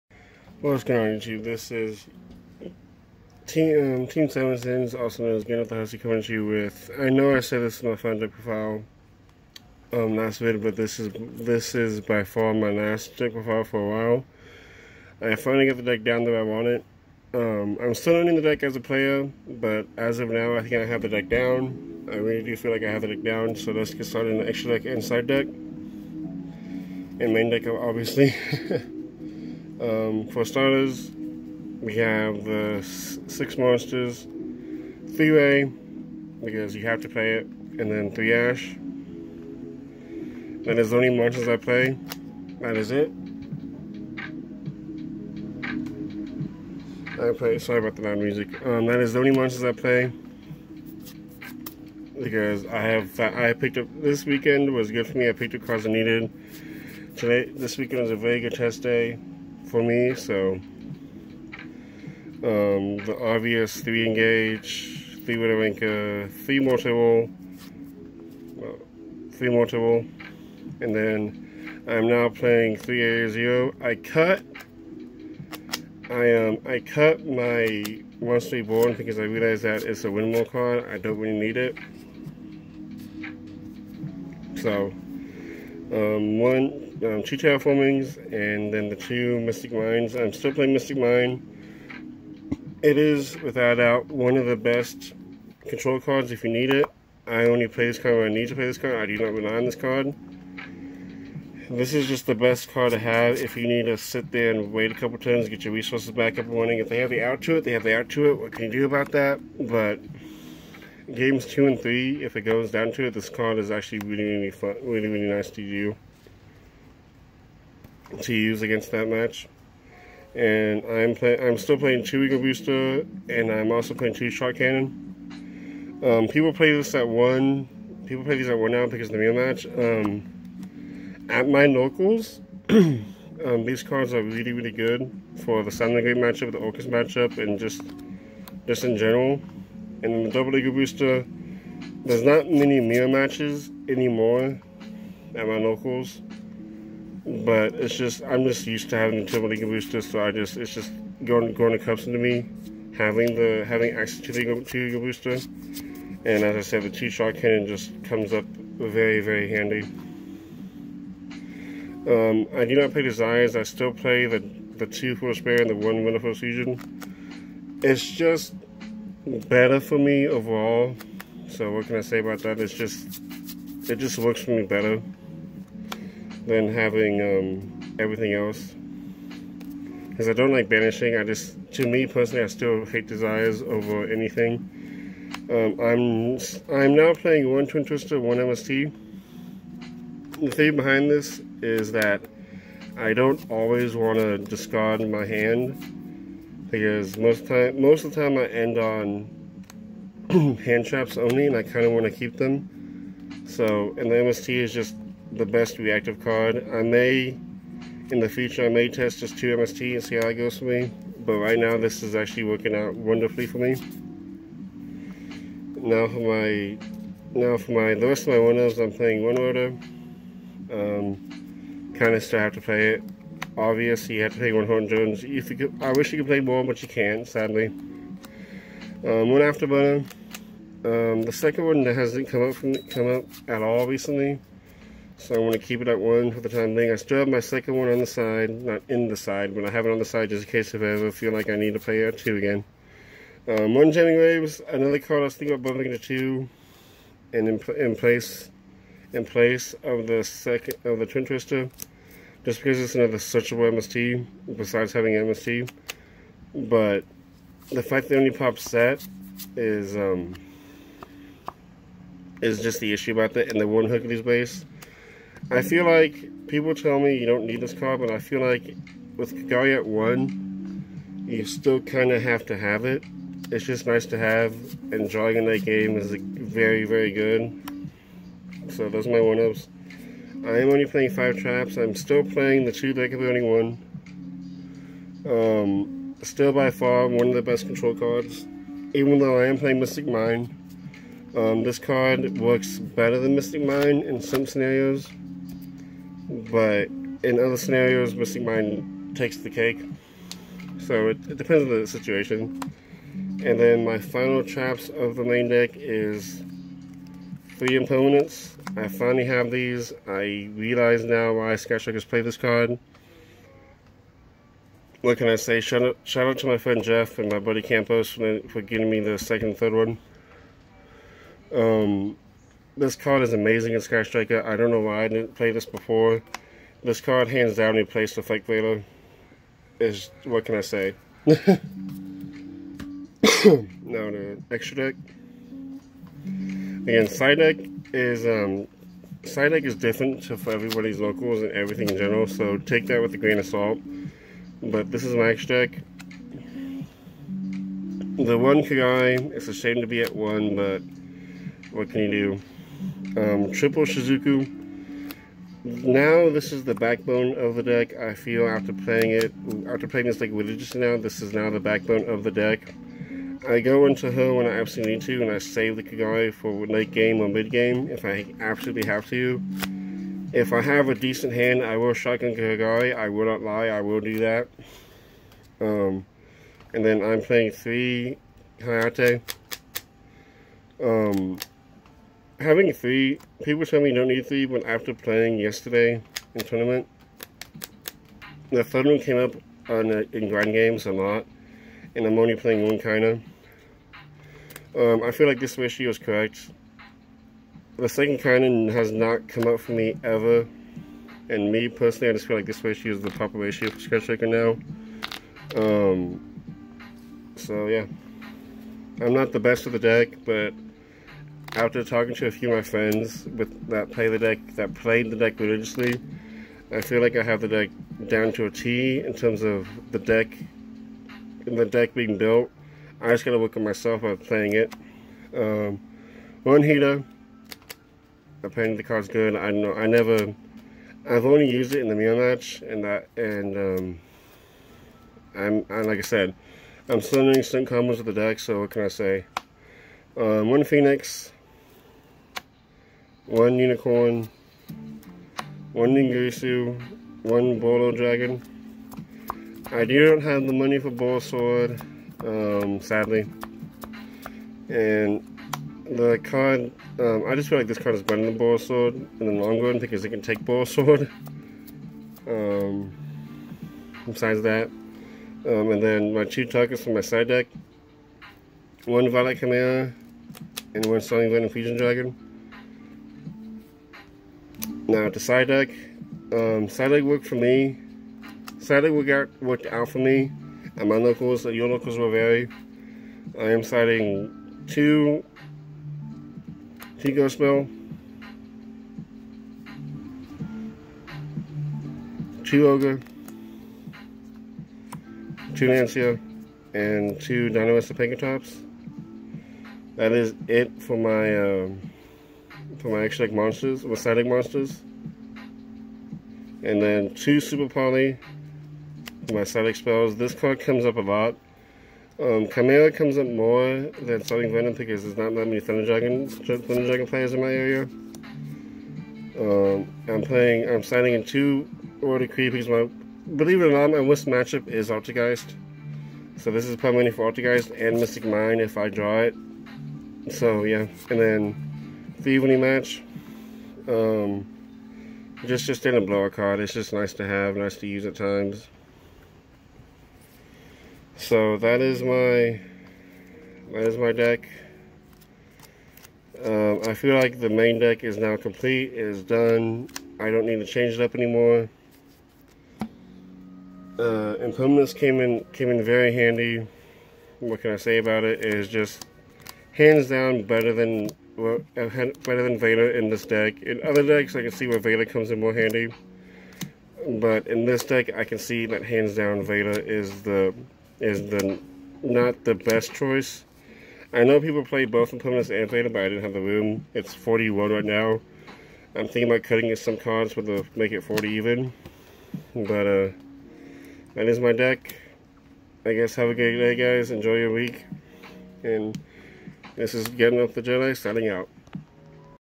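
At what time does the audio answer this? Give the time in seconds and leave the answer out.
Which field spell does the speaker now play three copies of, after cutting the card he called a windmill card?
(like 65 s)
72 s.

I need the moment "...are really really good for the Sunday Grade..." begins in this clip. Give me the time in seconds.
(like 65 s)
134 s.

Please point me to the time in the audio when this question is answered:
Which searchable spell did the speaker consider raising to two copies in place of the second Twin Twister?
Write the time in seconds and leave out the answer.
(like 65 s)
243 s.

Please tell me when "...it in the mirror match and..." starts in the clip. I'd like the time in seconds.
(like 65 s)
431 s.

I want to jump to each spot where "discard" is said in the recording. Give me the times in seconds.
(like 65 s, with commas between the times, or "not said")
194 s.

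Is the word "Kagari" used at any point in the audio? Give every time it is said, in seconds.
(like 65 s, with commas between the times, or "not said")
348 s, 365 s, 372 s.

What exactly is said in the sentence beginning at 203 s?
So, and the MST is just the best reactive card.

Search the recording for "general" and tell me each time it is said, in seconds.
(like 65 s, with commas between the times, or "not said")
138 s, 341 s.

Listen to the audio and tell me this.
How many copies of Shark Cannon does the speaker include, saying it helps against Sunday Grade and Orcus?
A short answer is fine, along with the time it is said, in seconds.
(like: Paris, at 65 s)
2, at 124 s.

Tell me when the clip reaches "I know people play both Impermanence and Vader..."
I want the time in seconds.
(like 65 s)
574 s.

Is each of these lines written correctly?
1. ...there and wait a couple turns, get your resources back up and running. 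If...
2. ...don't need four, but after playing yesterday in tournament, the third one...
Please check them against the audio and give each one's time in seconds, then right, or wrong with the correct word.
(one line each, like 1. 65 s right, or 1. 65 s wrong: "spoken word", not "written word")
1. 104 s right
2. 383 s wrong: "three", not "four".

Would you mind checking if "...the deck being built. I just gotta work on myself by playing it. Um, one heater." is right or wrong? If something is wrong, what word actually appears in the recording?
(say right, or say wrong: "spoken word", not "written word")
right.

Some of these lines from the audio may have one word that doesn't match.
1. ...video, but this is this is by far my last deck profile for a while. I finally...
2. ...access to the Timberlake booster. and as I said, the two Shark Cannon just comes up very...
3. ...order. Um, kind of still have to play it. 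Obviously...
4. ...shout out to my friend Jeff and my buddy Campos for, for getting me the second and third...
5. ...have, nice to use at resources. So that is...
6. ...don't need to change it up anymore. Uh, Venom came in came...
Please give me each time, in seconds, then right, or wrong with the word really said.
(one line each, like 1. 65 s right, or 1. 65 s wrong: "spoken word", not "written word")
1. 10 s right
2. 153 s right
3. 219 s right
4. 316 s right
5. 537 s wrong: "times", not "resources"
6. 550 s wrong: "Impermanence", not "Venom".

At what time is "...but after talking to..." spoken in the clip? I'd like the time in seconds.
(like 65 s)
410 s.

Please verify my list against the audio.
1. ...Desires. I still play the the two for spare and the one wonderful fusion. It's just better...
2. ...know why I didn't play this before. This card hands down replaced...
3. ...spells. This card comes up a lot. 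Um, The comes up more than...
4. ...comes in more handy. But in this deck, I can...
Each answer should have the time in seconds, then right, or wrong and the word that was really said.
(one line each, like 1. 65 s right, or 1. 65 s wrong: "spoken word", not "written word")
1. 163 s right
2. 324 s right
3. 509 s wrong: "Chimera", not "The"
4. 565 s right.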